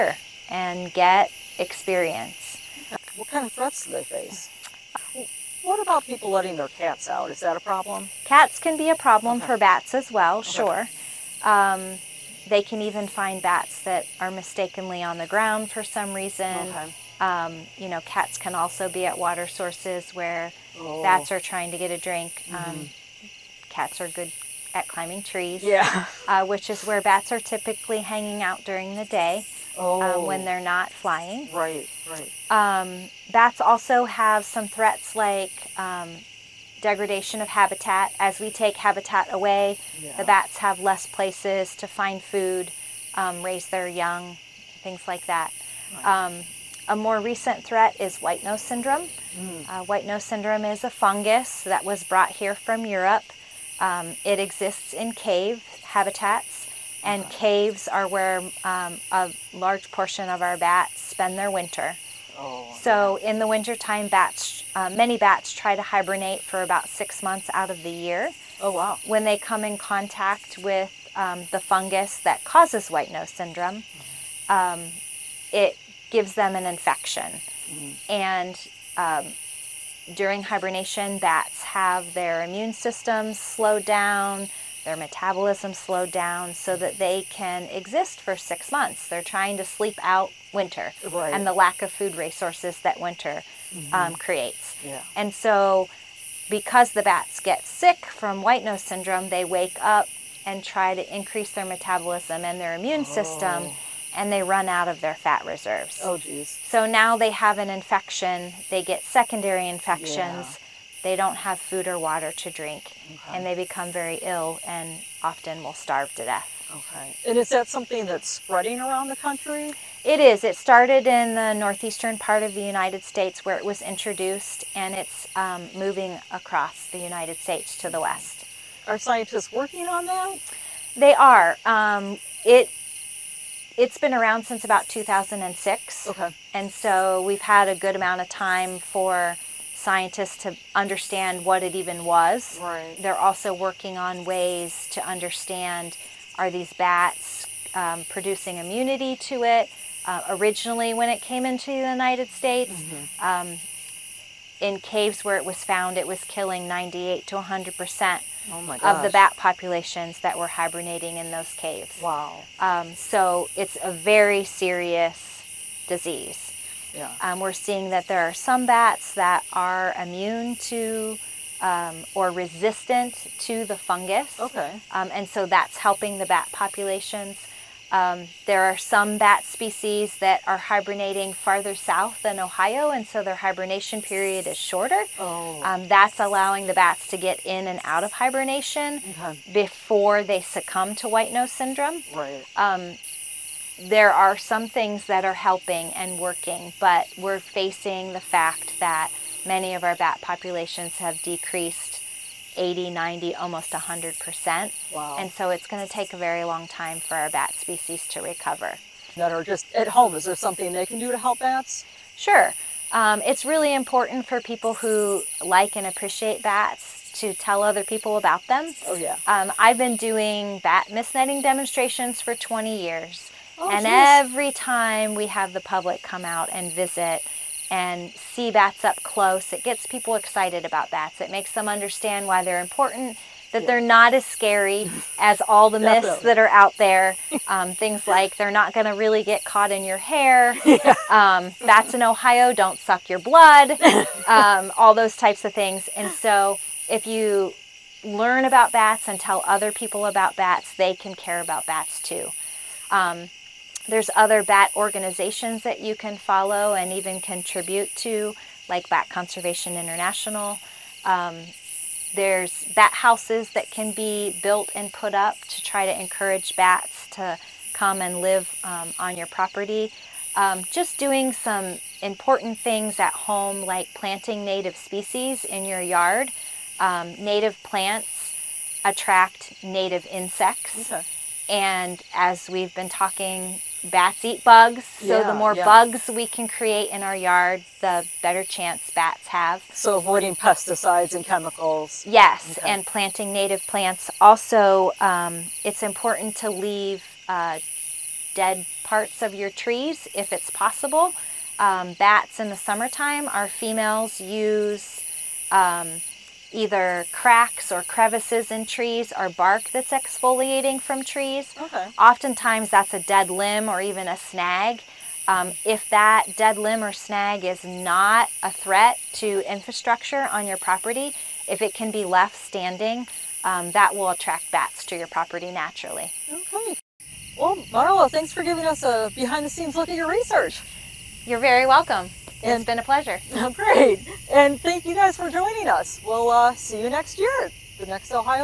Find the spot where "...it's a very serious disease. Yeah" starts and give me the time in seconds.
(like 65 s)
163 s.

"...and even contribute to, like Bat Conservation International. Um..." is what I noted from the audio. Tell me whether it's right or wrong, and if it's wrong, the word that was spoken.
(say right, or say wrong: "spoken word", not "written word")
right.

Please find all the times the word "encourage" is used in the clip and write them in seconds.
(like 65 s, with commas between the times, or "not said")
266 s.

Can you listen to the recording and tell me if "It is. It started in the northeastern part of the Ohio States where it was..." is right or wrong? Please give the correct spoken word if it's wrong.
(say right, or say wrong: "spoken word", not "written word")
wrong: "United", not "Ohio".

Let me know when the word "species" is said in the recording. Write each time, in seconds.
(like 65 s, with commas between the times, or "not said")
179 s, 207 s, 274 s.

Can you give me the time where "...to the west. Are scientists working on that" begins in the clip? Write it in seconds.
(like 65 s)
127 s.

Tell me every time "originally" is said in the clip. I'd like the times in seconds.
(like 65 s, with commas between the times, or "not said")
150 s.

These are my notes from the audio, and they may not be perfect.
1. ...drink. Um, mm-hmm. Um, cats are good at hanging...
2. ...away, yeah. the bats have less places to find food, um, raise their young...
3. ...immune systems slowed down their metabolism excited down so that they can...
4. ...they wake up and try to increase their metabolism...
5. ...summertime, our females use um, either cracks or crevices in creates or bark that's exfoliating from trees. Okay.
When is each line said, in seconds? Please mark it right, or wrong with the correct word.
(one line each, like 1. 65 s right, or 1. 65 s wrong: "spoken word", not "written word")
1. 21 s wrong: "climbing", not "hanging"
2. 39 s right
3. 82 s wrong: "slowed", not "excited"
4. 99 s right
5. 302 s wrong: "trees", not "creates".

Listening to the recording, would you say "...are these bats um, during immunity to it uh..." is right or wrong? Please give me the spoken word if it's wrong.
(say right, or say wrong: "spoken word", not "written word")
wrong: "producing", not "during".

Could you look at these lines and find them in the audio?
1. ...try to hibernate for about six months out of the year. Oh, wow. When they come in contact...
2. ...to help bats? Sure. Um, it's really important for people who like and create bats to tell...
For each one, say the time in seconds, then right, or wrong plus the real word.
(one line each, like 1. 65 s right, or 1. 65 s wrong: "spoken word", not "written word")
1. 65 s right
2. 211 s wrong: "appreciate", not "create".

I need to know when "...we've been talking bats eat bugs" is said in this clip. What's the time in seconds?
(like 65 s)
282 s.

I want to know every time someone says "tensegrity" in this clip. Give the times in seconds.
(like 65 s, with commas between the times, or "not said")
not said.